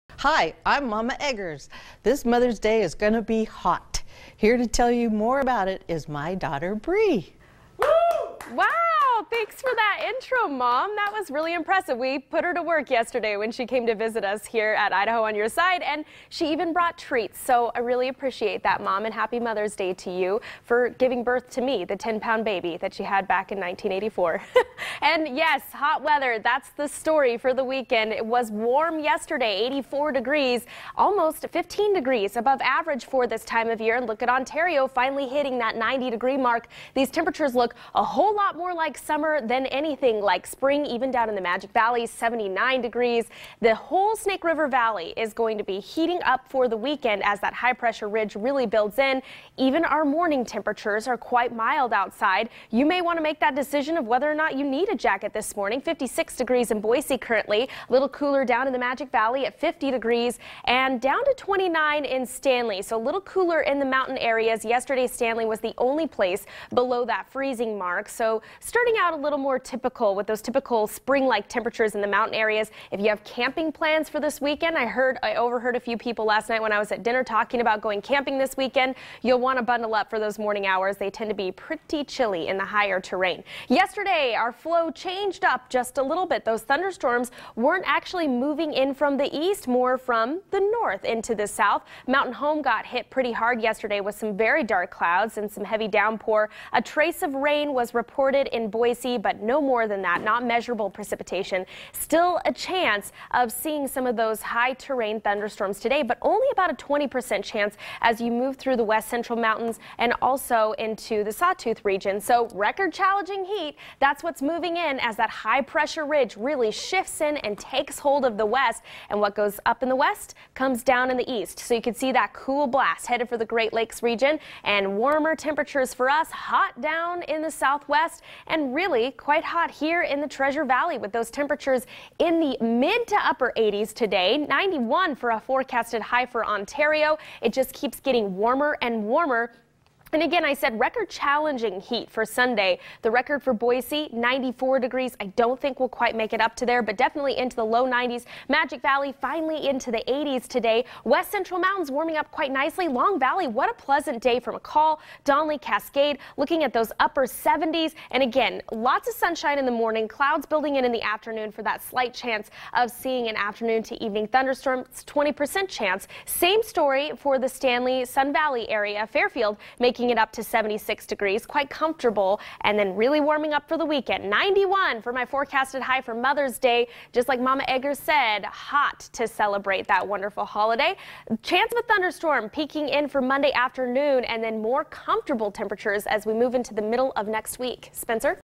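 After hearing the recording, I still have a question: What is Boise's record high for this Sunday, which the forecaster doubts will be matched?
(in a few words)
94 degrees.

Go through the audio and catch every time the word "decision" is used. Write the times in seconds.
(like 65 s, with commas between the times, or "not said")
53 s.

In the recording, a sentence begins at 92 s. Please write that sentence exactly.
Mountain Home got hit pretty hard yesterday with some very dark clouds and some heavy downpour.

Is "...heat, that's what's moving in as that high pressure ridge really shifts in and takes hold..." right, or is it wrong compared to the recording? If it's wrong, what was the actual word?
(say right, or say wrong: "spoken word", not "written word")
right.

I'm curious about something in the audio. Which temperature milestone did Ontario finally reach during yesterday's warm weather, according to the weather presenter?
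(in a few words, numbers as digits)
90 degrees.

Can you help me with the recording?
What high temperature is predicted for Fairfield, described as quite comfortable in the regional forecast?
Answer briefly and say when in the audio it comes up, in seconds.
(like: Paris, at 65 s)
76 degrees, at 170 s.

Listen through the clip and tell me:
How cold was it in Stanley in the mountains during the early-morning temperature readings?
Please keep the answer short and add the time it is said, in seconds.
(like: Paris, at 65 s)
29 degrees, at 61 s.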